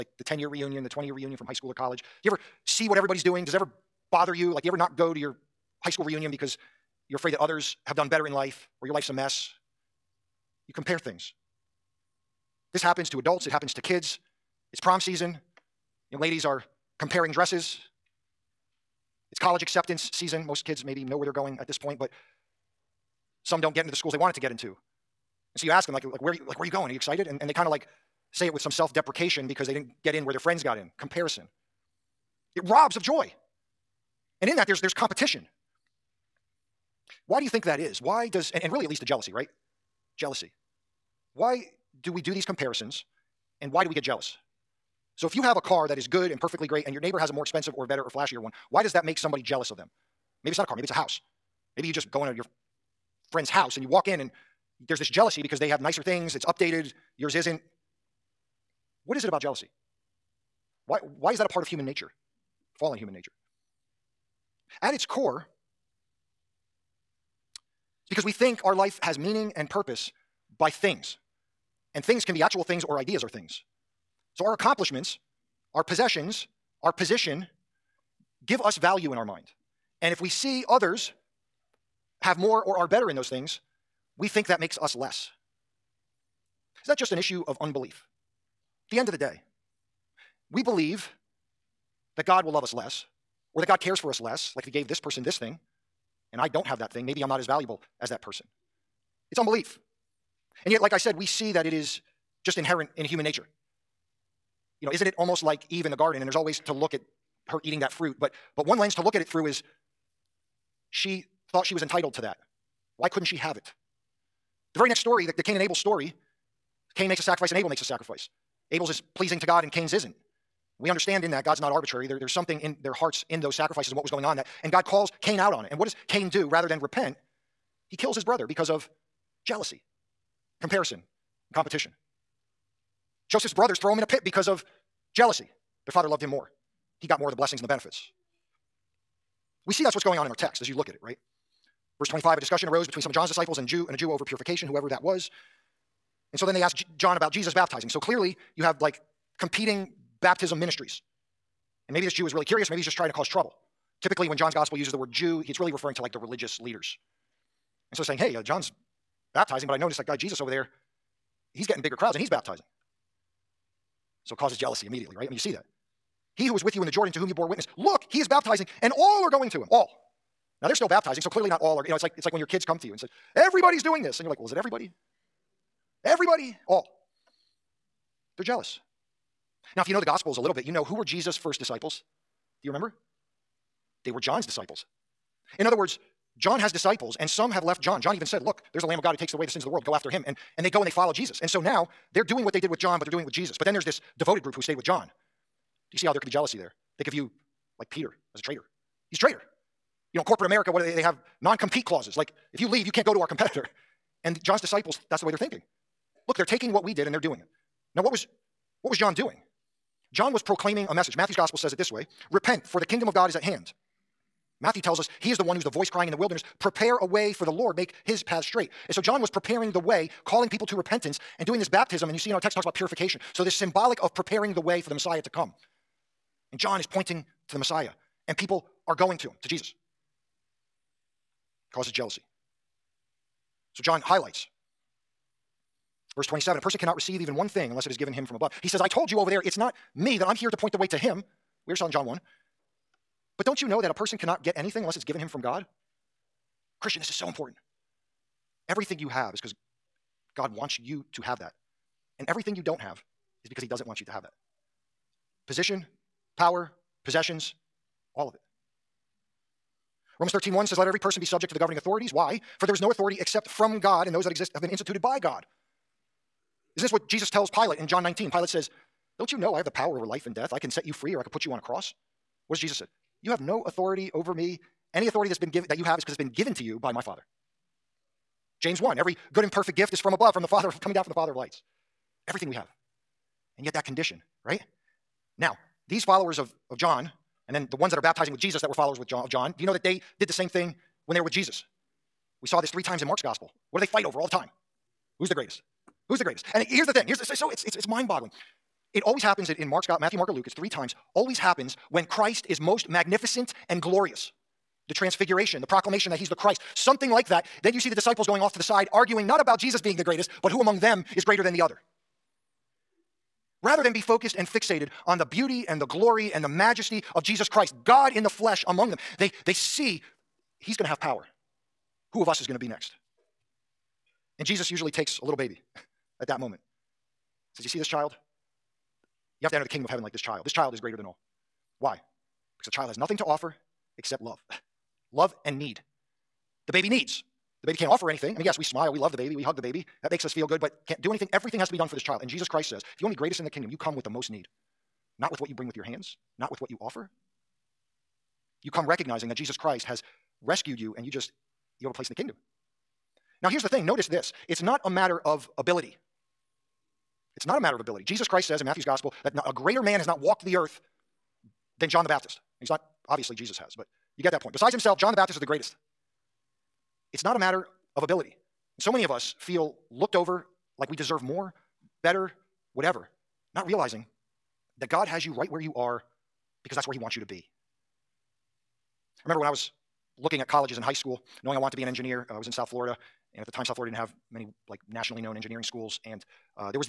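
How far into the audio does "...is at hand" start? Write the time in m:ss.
3:33.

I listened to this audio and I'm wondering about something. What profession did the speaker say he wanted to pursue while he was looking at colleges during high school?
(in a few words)
Engineer.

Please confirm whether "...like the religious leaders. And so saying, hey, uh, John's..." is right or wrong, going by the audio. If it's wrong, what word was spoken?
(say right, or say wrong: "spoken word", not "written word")
right.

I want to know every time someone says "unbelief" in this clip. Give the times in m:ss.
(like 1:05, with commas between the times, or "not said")
1:27, 1:39.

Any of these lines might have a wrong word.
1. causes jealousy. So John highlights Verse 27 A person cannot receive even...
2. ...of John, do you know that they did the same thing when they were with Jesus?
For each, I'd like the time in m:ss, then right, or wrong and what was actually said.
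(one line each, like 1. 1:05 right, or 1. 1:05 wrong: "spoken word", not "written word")
1. 3:51 right
2. 4:49 right.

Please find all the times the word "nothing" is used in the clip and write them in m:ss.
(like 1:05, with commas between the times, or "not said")
5:32.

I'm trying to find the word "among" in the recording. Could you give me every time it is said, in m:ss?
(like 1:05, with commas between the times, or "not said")
5:10, 5:18.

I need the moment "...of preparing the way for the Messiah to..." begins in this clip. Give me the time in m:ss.
3:44.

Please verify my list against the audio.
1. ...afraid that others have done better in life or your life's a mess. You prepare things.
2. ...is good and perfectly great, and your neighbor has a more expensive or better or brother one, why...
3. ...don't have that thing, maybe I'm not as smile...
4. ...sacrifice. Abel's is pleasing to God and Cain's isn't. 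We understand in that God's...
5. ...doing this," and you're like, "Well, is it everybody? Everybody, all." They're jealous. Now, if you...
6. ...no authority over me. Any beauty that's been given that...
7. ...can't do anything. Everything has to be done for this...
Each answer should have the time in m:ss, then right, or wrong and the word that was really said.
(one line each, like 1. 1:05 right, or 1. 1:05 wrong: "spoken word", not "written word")
1. 0:07 wrong: "compare", not "prepare"
2. 0:45 wrong: "flashier", not "brother"
3. 1:36 wrong: "valuable", not "smile"
4. 1:57 right
5. 2:53 right
6. 4:33 wrong: "authority", not "beauty"
7. 5:40 right.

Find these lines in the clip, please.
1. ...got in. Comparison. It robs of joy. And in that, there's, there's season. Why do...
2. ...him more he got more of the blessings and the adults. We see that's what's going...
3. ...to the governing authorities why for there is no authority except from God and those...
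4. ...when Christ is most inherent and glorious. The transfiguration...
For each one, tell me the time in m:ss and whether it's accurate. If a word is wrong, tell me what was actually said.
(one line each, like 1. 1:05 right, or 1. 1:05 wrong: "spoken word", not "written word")
1. 0:30 wrong: "competition", not "season"
2. 2:16 wrong: "benefits", not "adults"
3. 4:21 right
4. 5:01 wrong: "magnificent", not "inherent".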